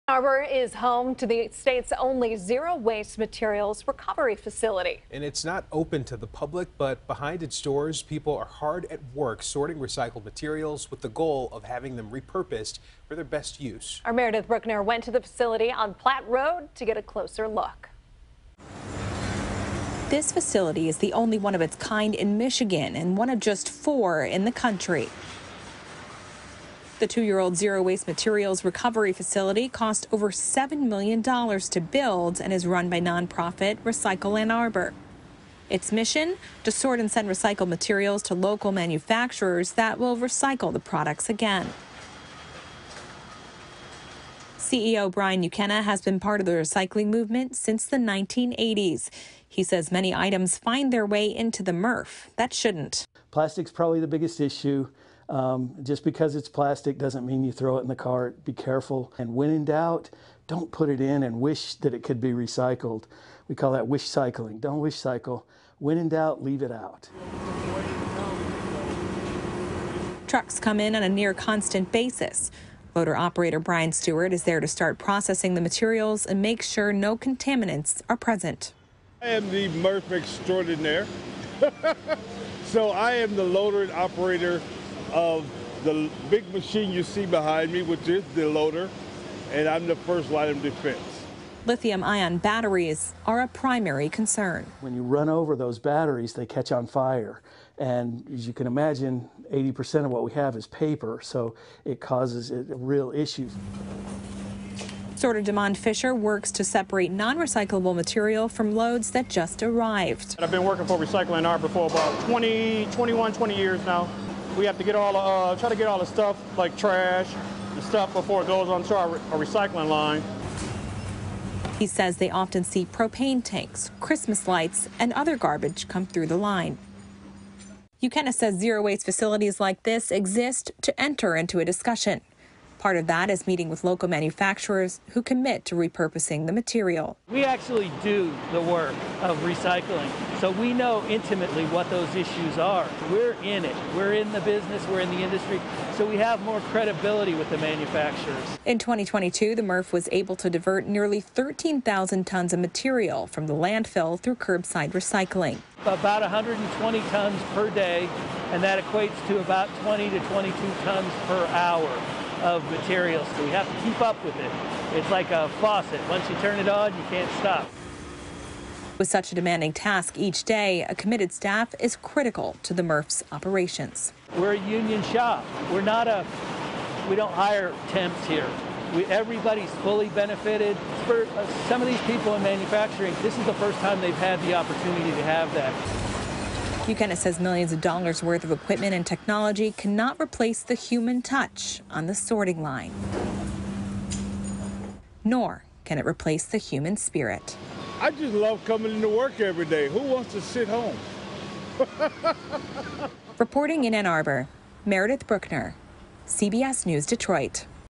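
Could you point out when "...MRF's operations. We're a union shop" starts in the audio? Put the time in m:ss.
2:52.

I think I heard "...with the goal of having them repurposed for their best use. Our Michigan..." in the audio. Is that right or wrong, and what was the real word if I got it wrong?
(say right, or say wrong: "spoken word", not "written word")
wrong: "Meredith", not "Michigan".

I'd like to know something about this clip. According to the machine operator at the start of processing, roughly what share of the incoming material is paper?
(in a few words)
80%.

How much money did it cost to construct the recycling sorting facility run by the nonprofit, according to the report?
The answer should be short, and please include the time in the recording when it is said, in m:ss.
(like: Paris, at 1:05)
over $7 million, at 0:30.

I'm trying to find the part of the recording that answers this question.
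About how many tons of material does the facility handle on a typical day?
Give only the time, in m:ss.
2:36.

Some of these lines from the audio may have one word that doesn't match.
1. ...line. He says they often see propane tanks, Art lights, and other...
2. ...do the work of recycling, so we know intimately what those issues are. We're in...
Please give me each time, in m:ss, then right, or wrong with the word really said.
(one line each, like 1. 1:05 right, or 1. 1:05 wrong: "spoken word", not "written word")
1. 1:59 wrong: "Christmas", not "Art"
2. 2:18 right.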